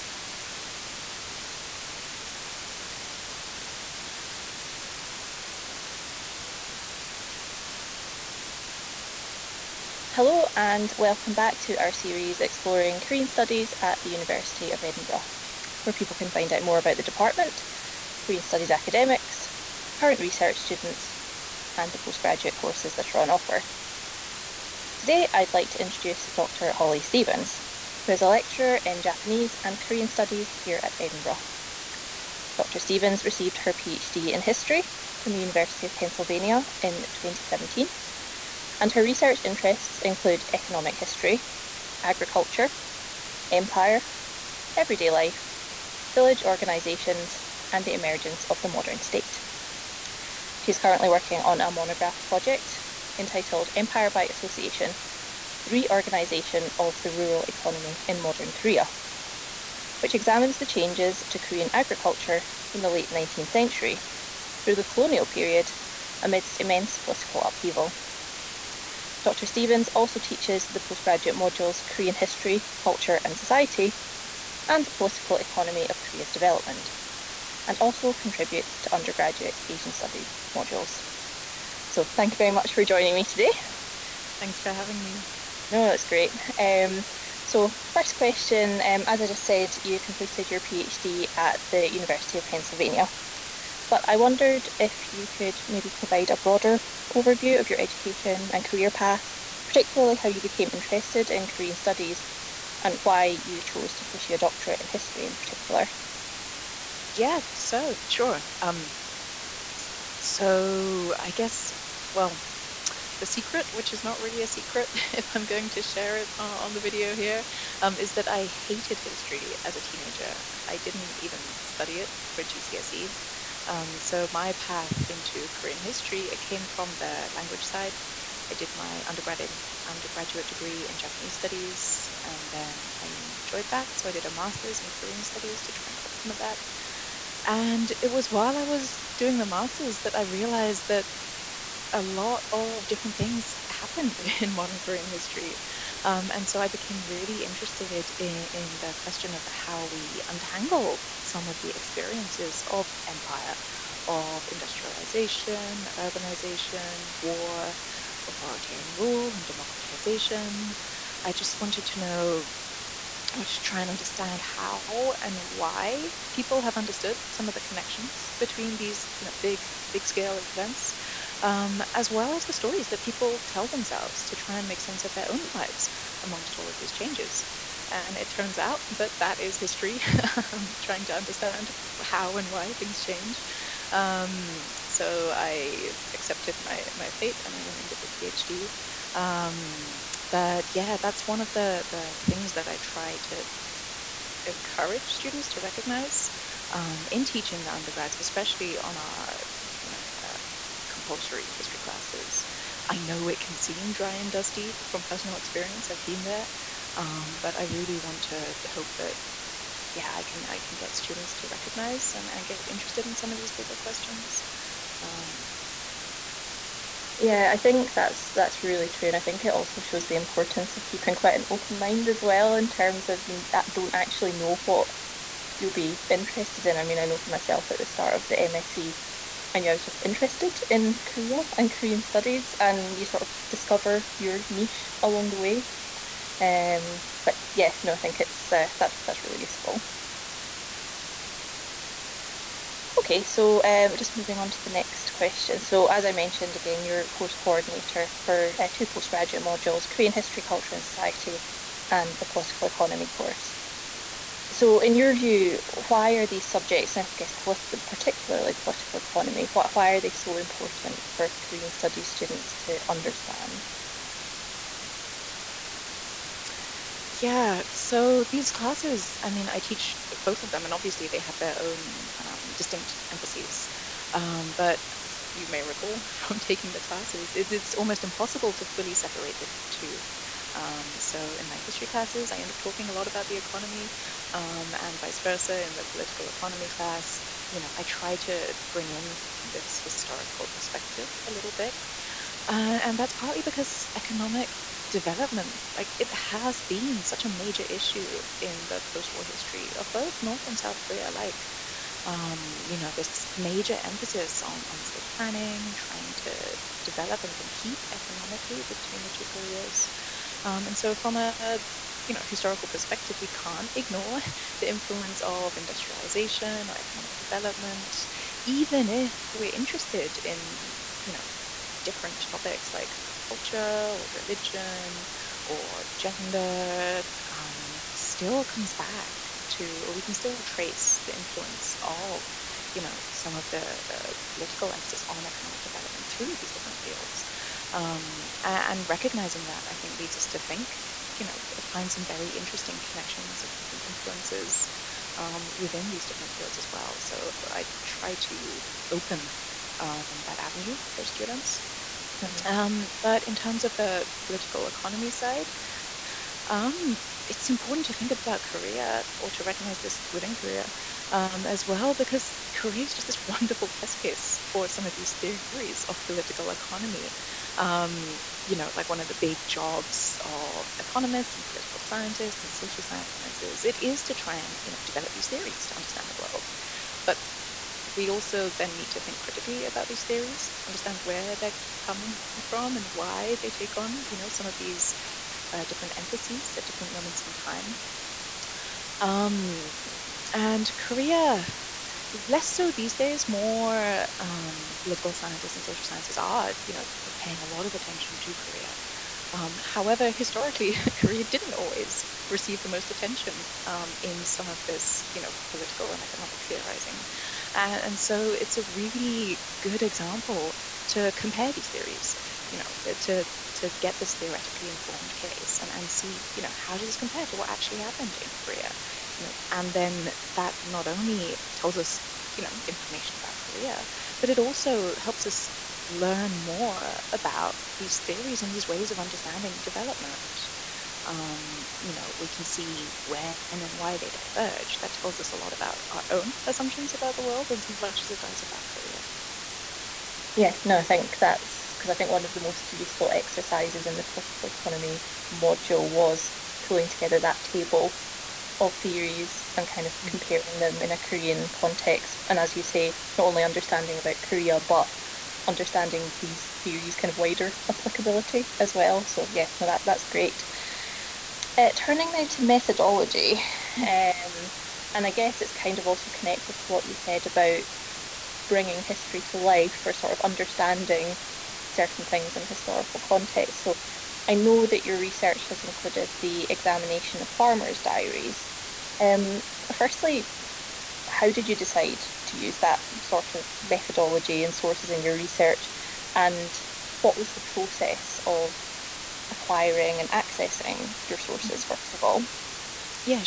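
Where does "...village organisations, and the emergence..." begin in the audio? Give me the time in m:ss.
0:46.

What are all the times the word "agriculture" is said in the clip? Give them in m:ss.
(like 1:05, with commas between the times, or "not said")
0:42, 1:01.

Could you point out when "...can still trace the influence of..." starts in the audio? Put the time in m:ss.
5:30.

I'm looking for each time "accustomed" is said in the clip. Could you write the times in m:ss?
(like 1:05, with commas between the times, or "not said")
not said.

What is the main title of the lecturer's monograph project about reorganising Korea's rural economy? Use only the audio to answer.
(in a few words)
Empire by Association.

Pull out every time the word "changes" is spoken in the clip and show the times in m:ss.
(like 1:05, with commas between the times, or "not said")
1:00, 2:56, 3:02.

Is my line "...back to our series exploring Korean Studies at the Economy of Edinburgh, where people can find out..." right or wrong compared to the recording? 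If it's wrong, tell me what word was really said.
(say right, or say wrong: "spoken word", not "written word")
wrong: "University", not "Economy".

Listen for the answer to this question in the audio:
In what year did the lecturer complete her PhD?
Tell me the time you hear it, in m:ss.
0:37.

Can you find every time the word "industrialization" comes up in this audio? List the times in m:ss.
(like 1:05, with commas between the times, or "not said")
2:34, 5:15.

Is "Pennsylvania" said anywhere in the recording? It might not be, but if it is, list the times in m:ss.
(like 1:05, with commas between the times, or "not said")
0:35, 1:32.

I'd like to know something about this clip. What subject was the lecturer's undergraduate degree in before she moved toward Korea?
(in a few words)
Japanese studies.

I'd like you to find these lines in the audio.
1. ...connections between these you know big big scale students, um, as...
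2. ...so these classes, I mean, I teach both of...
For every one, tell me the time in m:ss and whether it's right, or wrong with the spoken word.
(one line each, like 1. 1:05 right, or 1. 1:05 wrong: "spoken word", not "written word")
1. 2:47 wrong: "events", not "students"
2. 4:27 right.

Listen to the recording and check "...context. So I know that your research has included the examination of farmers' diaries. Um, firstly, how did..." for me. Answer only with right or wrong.
right.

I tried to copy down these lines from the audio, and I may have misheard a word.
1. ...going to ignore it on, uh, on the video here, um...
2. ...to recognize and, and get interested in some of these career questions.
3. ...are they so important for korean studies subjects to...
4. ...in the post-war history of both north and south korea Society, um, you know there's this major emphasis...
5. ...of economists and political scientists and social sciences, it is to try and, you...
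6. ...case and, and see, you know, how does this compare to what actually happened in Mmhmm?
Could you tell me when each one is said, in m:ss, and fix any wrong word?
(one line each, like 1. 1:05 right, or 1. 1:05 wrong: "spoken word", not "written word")
1. 1:55 wrong: "share", not "ignore"
2. 3:31 wrong: "bigger", not "career"
3. 4:19 wrong: "students", not "subjects"
4. 4:58 wrong: "Like", not "Society"
5. 6:10 right
6. 6:55 wrong: "Korea", not "Mmhmm".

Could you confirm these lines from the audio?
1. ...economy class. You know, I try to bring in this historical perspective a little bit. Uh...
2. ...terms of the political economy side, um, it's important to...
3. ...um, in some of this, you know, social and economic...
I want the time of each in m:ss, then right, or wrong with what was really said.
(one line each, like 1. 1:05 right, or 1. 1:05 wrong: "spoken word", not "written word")
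1. 4:46 right
2. 5:53 right
3. 6:43 wrong: "political", not "social".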